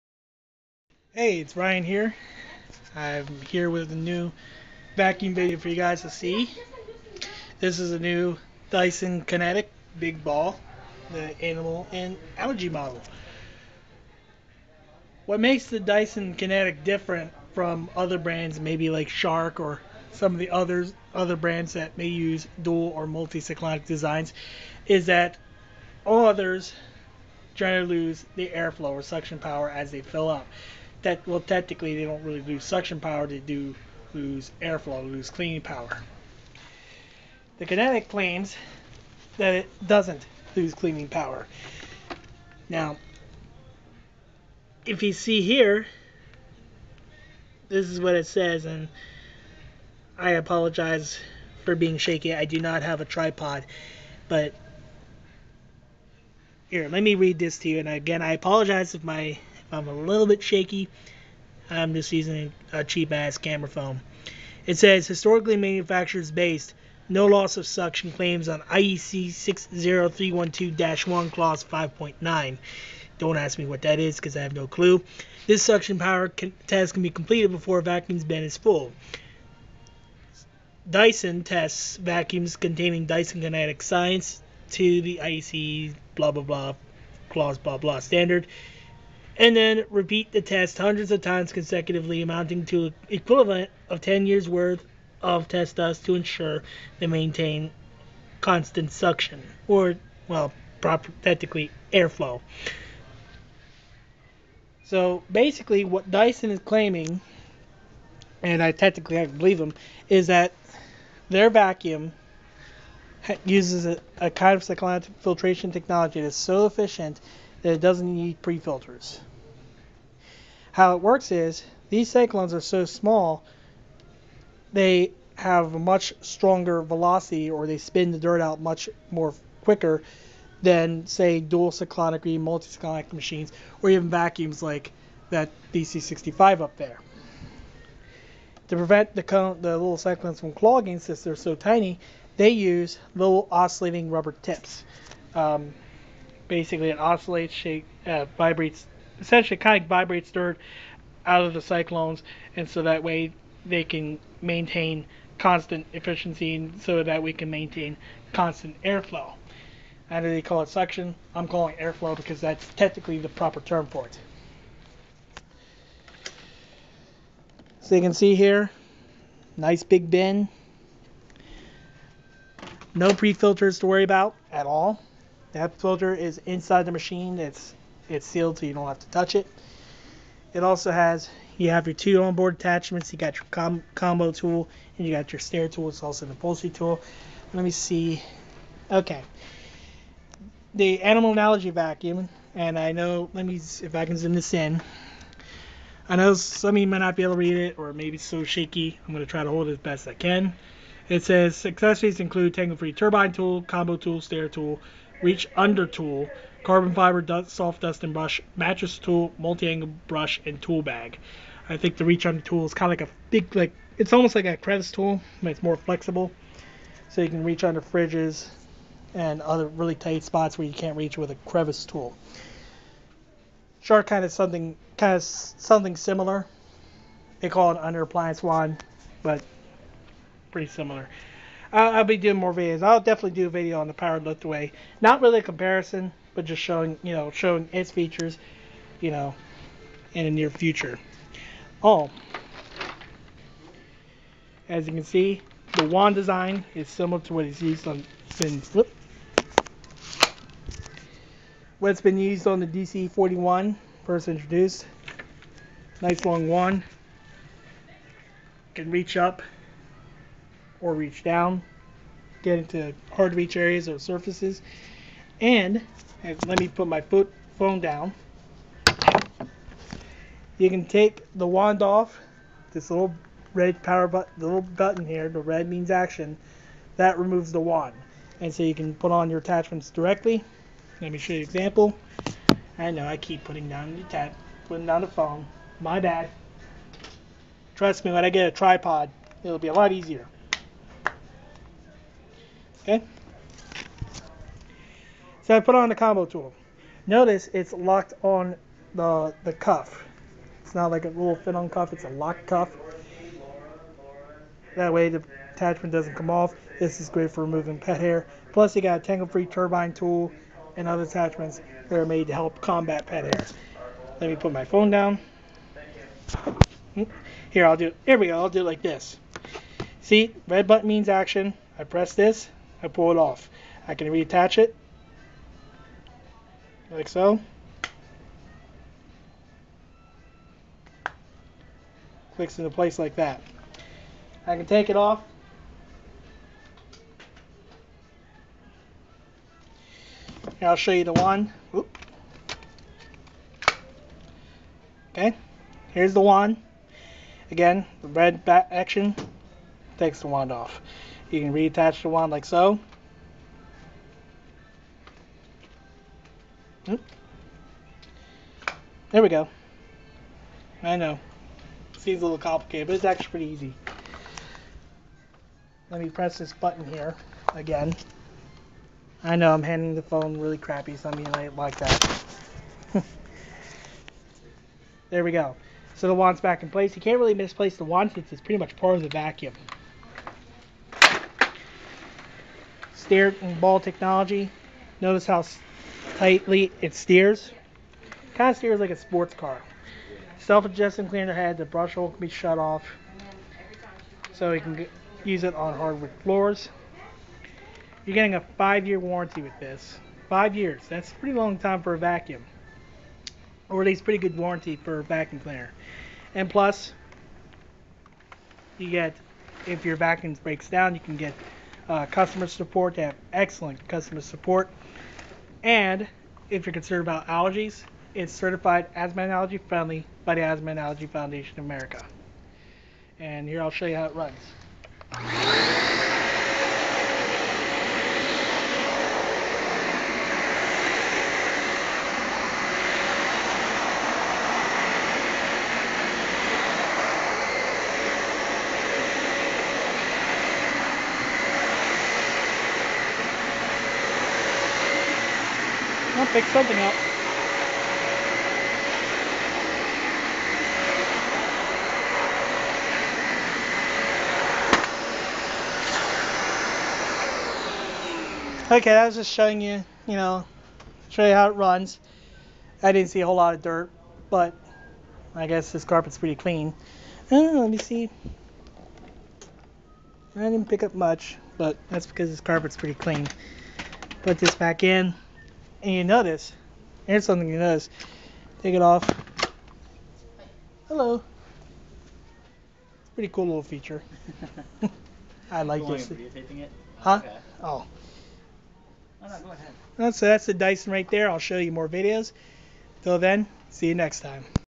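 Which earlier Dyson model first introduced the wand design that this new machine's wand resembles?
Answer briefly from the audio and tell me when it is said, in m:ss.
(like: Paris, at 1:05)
DC-41, at 4:12.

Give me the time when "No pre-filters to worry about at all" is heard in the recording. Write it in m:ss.
2:52.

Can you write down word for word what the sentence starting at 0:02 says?
I'm here with a new vacuum video for you guys to see.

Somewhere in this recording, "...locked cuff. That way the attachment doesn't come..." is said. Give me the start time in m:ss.
5:02.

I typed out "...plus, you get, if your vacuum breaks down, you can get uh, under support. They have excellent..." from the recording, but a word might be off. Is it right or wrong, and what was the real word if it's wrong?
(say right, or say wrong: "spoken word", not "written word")
wrong: "customer", not "under".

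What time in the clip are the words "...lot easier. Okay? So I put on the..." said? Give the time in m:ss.
4:49.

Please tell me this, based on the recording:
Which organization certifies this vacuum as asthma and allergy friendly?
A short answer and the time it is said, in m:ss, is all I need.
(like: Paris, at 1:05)
Asthma and Allergy Foundation of America, at 7:00.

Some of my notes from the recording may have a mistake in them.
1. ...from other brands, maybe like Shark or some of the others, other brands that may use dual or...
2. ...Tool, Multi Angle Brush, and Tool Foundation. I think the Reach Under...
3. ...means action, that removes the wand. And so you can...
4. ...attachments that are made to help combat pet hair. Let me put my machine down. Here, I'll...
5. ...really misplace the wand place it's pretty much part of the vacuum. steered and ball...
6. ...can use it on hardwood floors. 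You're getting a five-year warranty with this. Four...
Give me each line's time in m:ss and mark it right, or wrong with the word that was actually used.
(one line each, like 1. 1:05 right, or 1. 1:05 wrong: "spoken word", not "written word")
1. 0:17 right
2. 3:28 wrong: "Bag", not "Foundation"
3. 4:35 right
4. 5:11 wrong: "phone", not "machine"
5. 6:17 wrong: "since", not "place"
6. 6:34 wrong: "Five", not "Four".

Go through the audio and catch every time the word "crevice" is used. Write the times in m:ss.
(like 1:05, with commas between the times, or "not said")
3:34, 3:41.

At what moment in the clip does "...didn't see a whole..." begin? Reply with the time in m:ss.
7:42.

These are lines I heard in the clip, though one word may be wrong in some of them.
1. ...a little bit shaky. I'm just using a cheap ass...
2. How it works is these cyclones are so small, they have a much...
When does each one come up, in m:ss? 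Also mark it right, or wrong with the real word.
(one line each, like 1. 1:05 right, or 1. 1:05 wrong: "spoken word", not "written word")
1. 0:59 right
2. 2:00 right.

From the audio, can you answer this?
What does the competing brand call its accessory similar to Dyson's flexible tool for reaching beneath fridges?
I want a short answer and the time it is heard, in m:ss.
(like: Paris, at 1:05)
under appliance wand, at 3:47.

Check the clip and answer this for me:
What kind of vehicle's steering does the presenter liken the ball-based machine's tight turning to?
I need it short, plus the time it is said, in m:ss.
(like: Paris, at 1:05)
sports car, at 6:28.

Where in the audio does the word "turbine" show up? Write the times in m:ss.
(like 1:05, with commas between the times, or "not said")
3:22, 5:09.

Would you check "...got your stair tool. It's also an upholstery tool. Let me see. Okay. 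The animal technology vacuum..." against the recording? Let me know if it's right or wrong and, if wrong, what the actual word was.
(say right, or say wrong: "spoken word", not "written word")
wrong: "analogy", not "technology".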